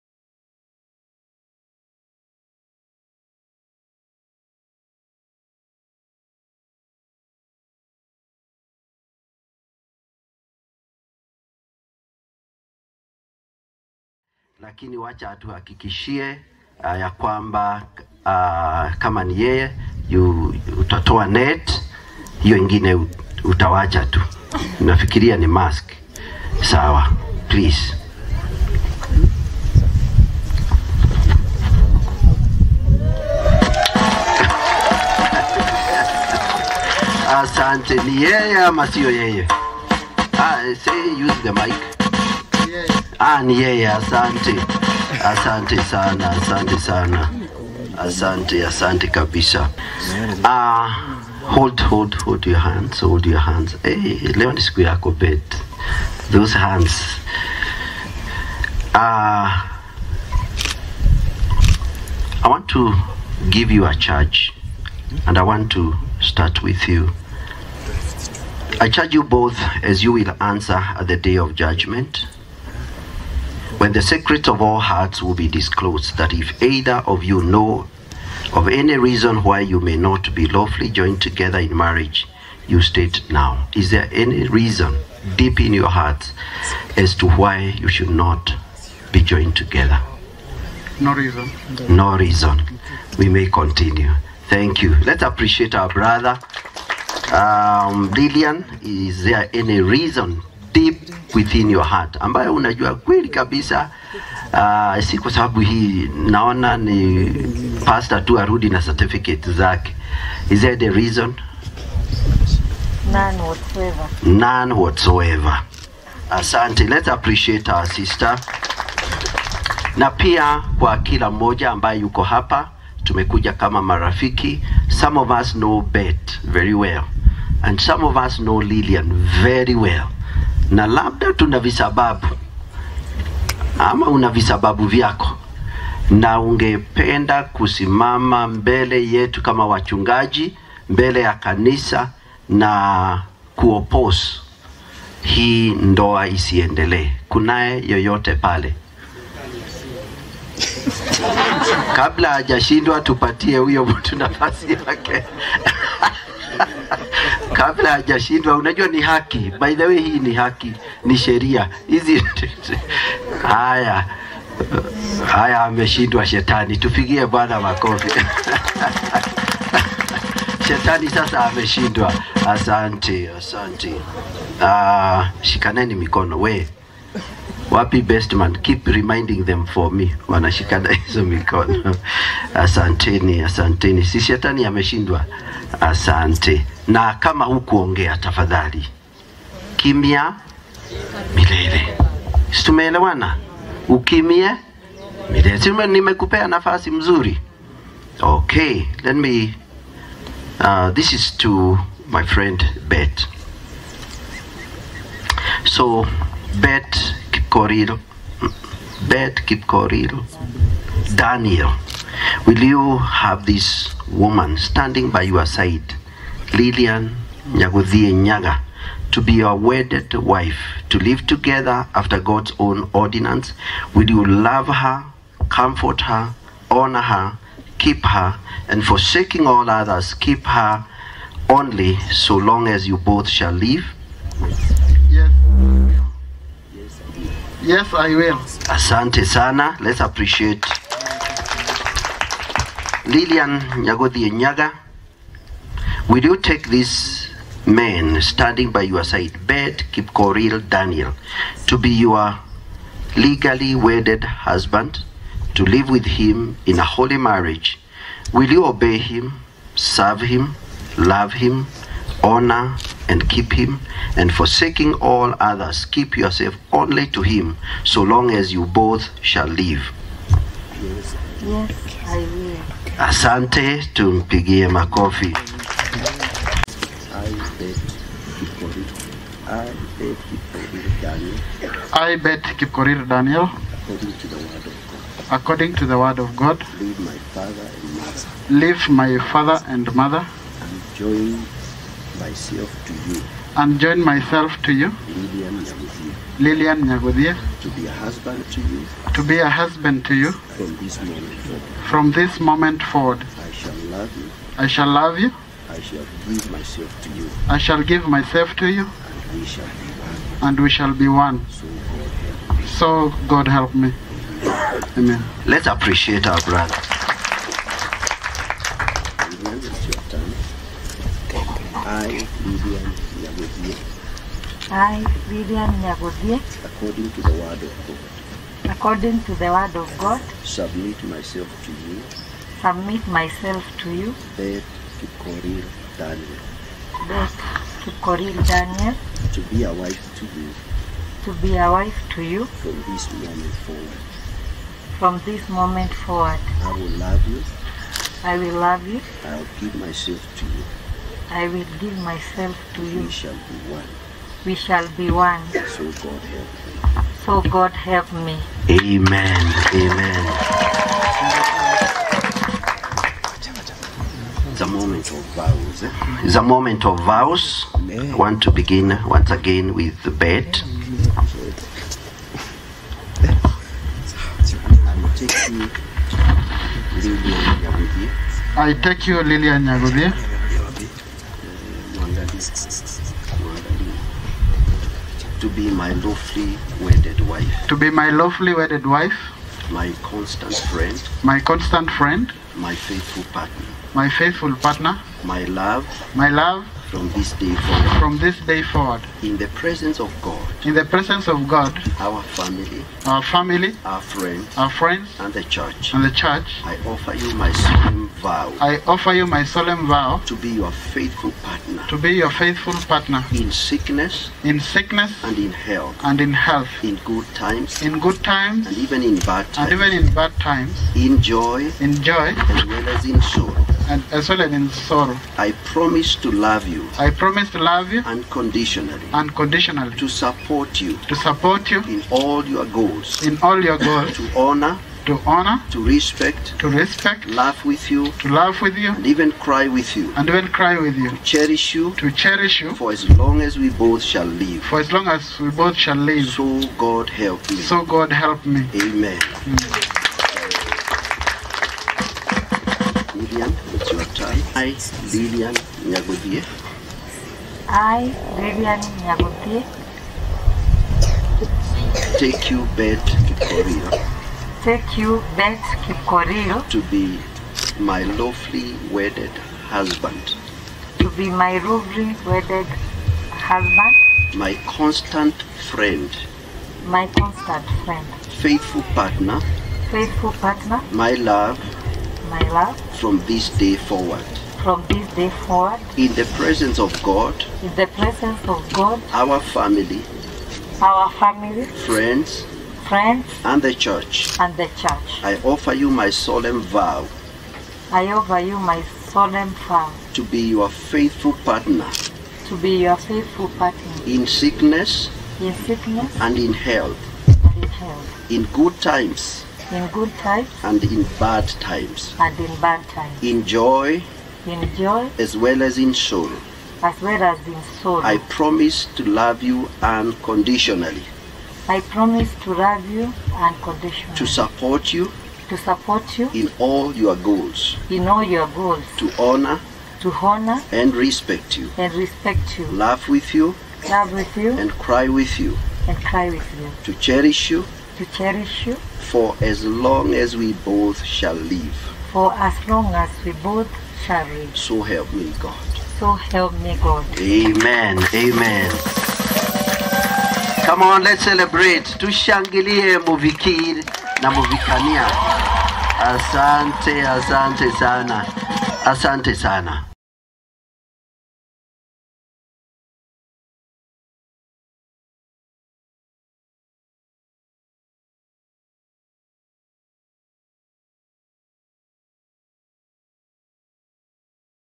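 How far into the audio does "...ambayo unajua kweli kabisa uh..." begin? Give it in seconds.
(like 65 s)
102 s.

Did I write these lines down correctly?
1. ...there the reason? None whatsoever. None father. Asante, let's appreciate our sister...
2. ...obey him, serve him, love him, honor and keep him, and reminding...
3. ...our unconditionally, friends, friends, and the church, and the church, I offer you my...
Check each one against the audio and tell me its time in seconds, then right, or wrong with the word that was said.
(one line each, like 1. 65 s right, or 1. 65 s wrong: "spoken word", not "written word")
1. 110 s wrong: "whatsoever", not "father"
2. 258 s wrong: "forsaking", not "reminding"
3. 490 s wrong: "family", not "unconditionally".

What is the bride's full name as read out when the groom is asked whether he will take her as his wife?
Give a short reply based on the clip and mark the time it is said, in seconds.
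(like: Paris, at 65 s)
Lilian Nyaguthie Nyaga, at 216 s.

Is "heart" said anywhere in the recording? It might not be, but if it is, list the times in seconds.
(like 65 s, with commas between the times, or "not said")
74 s, 85 s, 101 s.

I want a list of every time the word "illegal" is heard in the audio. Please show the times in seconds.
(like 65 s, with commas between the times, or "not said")
not said.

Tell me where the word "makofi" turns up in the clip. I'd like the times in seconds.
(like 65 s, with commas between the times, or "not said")
167 s, 274 s.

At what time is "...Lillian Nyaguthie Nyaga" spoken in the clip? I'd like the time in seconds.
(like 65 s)
243 s.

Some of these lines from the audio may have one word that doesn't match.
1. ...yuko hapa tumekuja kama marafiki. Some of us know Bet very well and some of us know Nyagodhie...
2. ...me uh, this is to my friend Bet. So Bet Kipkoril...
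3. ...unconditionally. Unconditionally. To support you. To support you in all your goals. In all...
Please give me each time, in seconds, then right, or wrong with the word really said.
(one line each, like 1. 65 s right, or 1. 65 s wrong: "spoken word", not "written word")
1. 121 s wrong: "Lillian", not "Nyagodhie"
2. 199 s right
3. 428 s right.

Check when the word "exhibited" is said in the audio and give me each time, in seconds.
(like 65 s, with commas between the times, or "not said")
not said.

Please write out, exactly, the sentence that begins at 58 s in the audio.
Ah, I want to give you a charge and I want to start with you.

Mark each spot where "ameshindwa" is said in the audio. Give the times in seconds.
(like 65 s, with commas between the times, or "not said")
165 s, 171 s, 184 s.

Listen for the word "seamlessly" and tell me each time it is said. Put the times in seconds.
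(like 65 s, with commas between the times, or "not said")
not said.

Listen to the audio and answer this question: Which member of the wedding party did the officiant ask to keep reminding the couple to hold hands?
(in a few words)
Best man.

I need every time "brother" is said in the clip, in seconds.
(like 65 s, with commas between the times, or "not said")
95 s, 316 s.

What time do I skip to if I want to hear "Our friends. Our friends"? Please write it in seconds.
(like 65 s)
403 s.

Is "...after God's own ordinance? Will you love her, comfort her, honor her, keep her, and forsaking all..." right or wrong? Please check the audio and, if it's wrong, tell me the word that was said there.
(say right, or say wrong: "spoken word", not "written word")
right.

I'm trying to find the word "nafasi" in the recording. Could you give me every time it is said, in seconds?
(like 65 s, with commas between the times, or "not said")
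154 s, 196 s.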